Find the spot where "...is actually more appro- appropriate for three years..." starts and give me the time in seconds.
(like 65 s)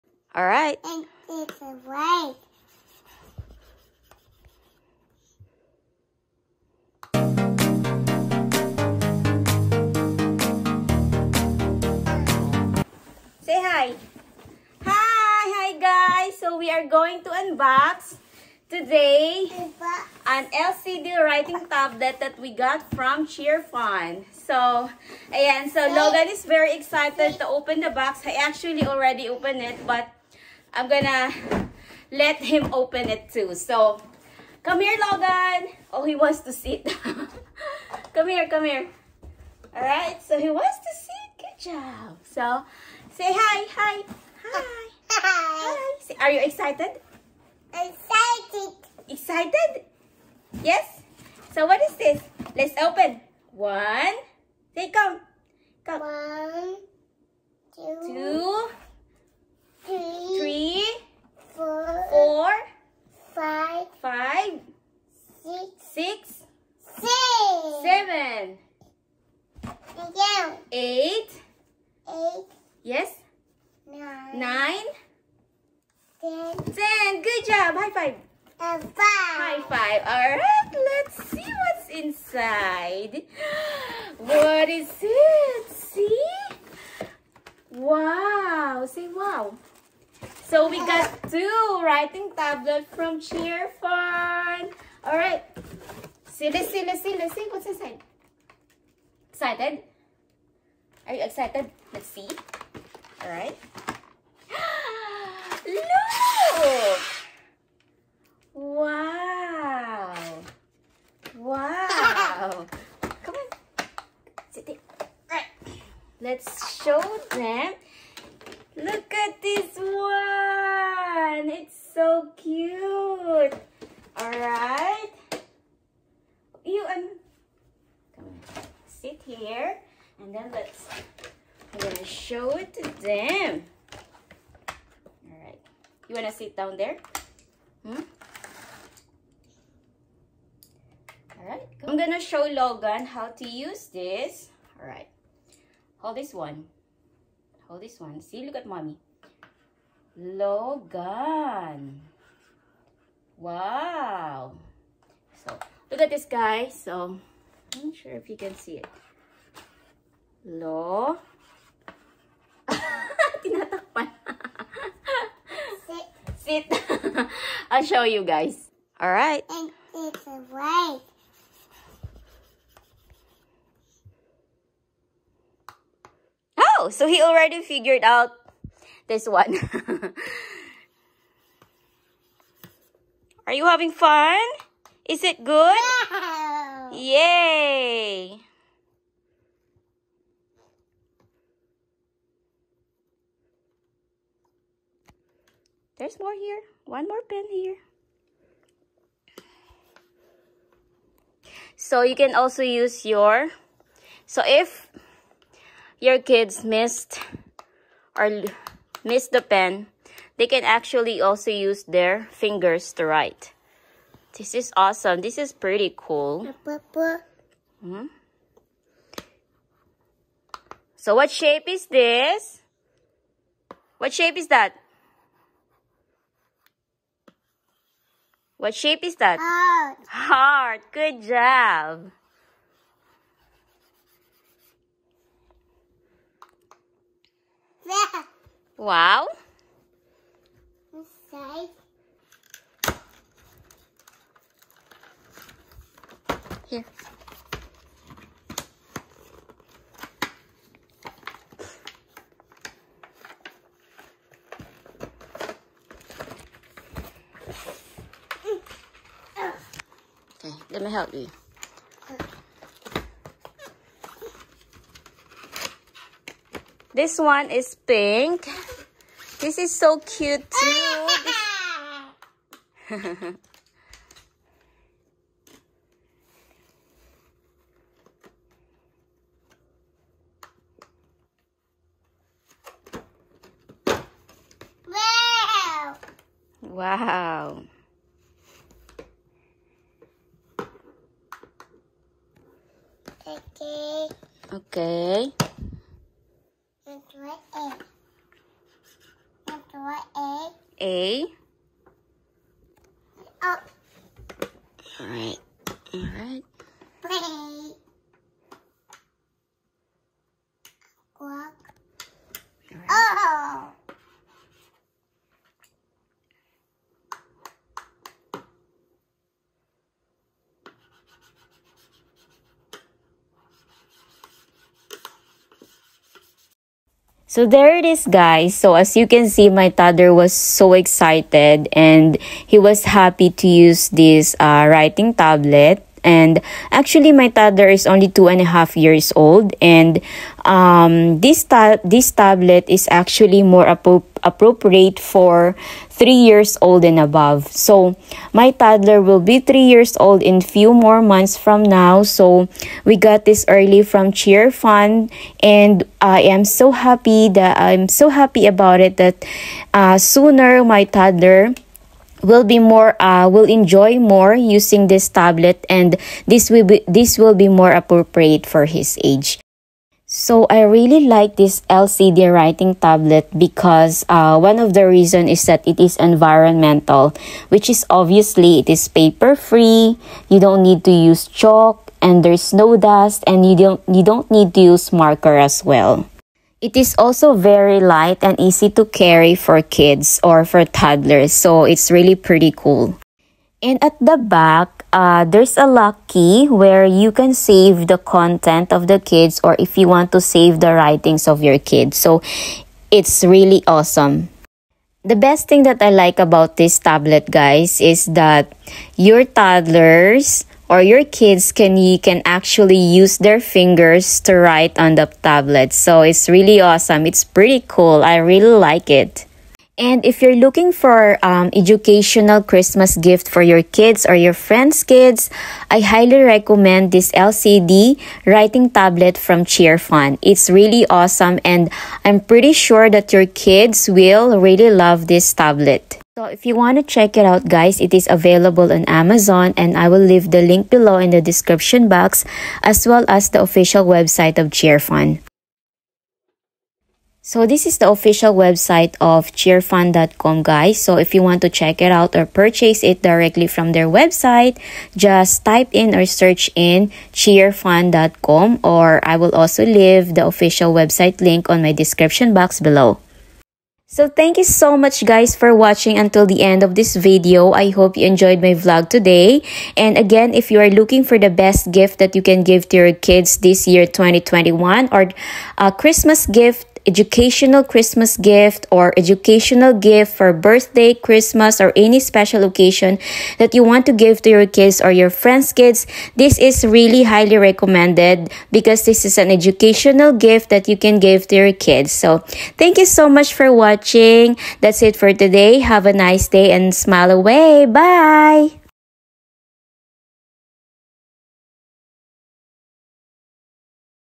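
342 s.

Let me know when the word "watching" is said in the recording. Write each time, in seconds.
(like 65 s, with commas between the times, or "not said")
465 s, 493 s.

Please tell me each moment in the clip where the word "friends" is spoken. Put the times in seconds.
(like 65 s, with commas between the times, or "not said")
424 s, 485 s.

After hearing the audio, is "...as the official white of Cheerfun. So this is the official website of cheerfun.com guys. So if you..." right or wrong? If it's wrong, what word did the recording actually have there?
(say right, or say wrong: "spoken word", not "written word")
wrong: "website", not "white".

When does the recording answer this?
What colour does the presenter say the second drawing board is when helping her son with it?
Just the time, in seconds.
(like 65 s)
267 s.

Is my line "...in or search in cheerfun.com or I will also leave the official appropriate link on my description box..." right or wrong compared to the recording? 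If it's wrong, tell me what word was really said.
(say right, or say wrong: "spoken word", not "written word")
wrong: "website", not "appropriate".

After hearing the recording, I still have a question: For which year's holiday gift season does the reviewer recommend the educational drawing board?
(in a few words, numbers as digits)
2021.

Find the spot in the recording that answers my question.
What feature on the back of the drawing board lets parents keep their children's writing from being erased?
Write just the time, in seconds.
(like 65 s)
395 s.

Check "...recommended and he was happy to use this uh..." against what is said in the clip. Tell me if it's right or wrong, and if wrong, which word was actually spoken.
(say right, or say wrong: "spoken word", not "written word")
wrong: "excited", not "recommended".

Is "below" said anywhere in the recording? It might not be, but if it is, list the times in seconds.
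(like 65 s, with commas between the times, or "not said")
440 s, 462 s.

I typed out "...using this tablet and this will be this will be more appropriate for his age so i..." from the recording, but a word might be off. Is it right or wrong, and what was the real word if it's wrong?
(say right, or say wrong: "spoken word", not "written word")
right.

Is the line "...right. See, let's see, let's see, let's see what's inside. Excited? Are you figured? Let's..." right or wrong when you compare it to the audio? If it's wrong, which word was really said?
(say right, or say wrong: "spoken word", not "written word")
wrong: "excited", not "figured".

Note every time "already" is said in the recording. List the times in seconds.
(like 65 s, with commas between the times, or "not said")
28 s, 177 s.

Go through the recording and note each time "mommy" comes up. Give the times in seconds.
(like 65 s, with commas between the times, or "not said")
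148 s.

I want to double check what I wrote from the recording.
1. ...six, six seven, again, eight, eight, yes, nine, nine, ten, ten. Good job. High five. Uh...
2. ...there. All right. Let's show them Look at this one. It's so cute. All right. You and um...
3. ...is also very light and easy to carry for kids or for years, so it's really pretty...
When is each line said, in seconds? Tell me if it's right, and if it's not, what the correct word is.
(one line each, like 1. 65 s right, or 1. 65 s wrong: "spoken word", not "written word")
1. 65 s right
2. 114 s right
3. 386 s wrong: "toddlers", not "years".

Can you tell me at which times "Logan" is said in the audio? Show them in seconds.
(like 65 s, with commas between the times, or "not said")
25 s, 35 s, 142 s, 150 s.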